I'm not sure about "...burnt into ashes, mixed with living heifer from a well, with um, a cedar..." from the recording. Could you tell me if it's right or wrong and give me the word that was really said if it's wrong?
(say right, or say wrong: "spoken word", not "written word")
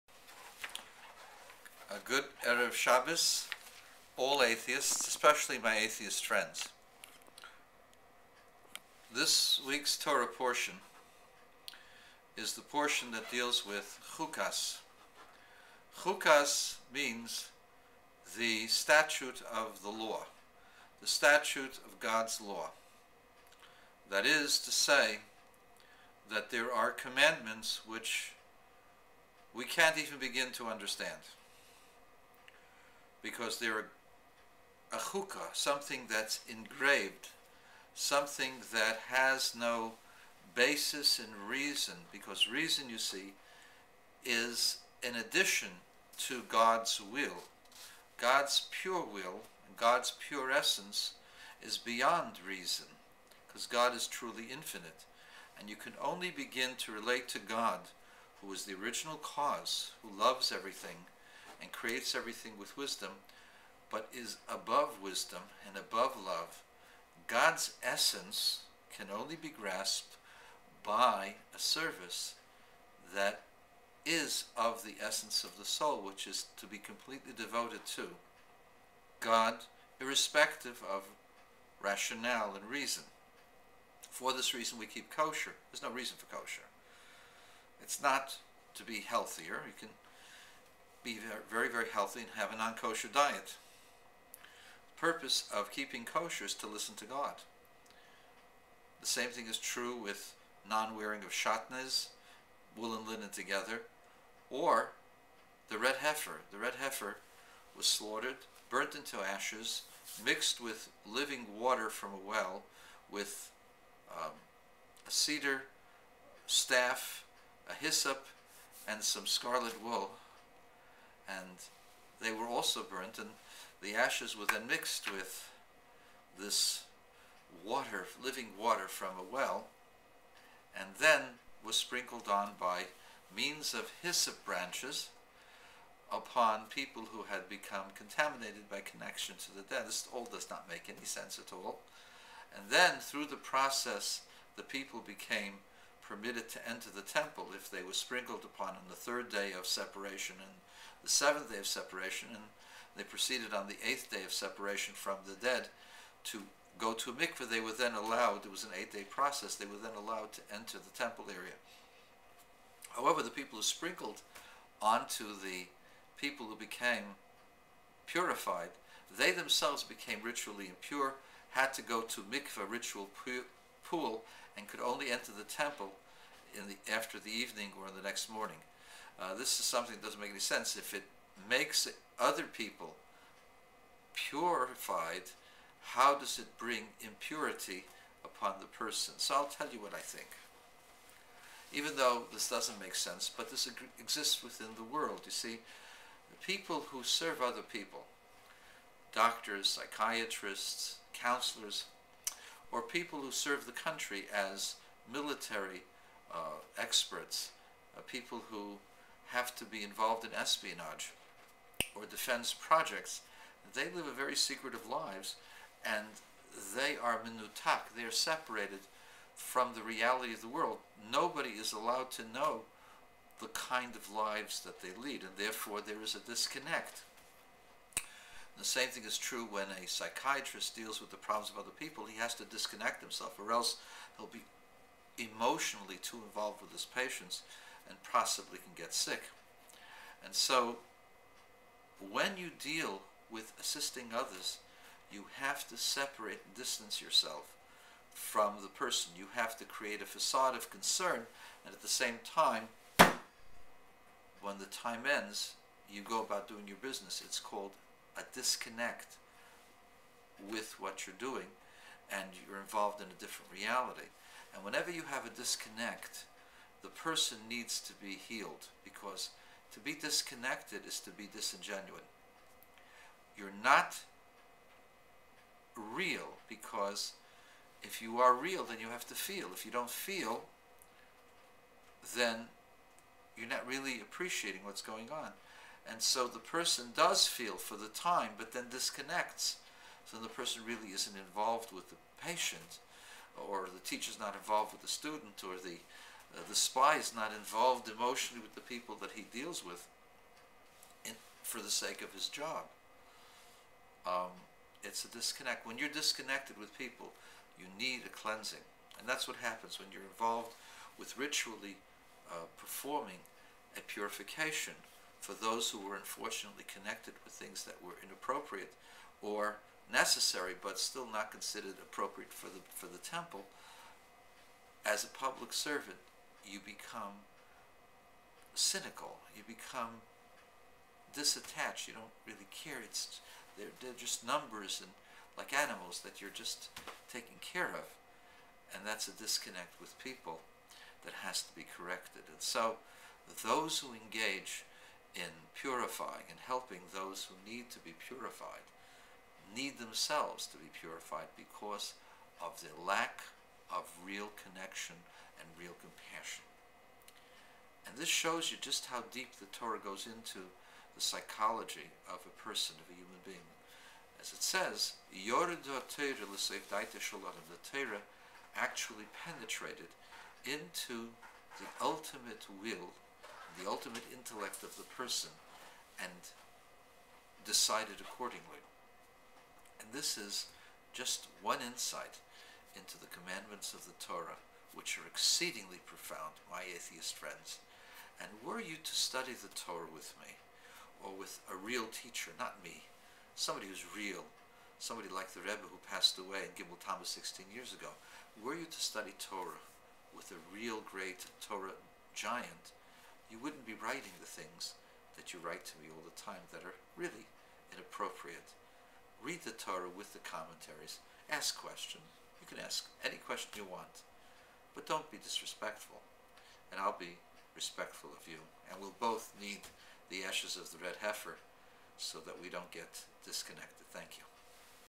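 wrong: "water", not "heifer".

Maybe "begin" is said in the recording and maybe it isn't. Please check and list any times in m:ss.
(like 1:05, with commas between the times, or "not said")
0:30, 0:56.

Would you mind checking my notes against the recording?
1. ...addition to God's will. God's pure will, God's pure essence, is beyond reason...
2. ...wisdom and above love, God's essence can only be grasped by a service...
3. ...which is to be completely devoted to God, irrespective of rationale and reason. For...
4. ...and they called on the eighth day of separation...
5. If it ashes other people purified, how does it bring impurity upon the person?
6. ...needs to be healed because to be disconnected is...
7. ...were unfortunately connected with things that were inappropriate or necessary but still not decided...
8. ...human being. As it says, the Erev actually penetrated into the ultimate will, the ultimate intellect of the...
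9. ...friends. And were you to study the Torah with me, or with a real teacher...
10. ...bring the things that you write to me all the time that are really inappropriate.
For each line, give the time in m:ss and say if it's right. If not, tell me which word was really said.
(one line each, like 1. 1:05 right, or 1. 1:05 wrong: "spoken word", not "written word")
1. 0:45 right
2. 1:05 right
3. 1:16 right
4. 2:32 wrong: "proceeded", not "called"
5. 3:00 wrong: "makes", not "ashes"
6. 4:27 right
7. 5:15 wrong: "considered", not "decided"
8. 6:02 wrong: "Torah", not "Erev"
9. 6:27 right
10. 6:43 wrong: "writing", not "bring".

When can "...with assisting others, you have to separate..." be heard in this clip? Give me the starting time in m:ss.
4:03.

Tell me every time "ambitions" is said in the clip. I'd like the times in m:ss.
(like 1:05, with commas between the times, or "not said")
not said.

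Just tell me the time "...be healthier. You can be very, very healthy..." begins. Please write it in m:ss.
1:28.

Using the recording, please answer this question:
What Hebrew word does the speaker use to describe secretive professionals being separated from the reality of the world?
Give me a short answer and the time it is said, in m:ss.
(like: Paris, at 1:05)
minutak, at 3:37.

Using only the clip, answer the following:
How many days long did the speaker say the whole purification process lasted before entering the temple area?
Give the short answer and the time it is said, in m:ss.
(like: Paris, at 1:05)
8, at 2:38.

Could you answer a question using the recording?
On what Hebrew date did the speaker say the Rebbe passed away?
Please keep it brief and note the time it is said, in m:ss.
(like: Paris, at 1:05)
Gimel Tammuz, at 6:36.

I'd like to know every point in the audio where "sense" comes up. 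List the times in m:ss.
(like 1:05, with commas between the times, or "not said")
2:21, 3:00, 3:12.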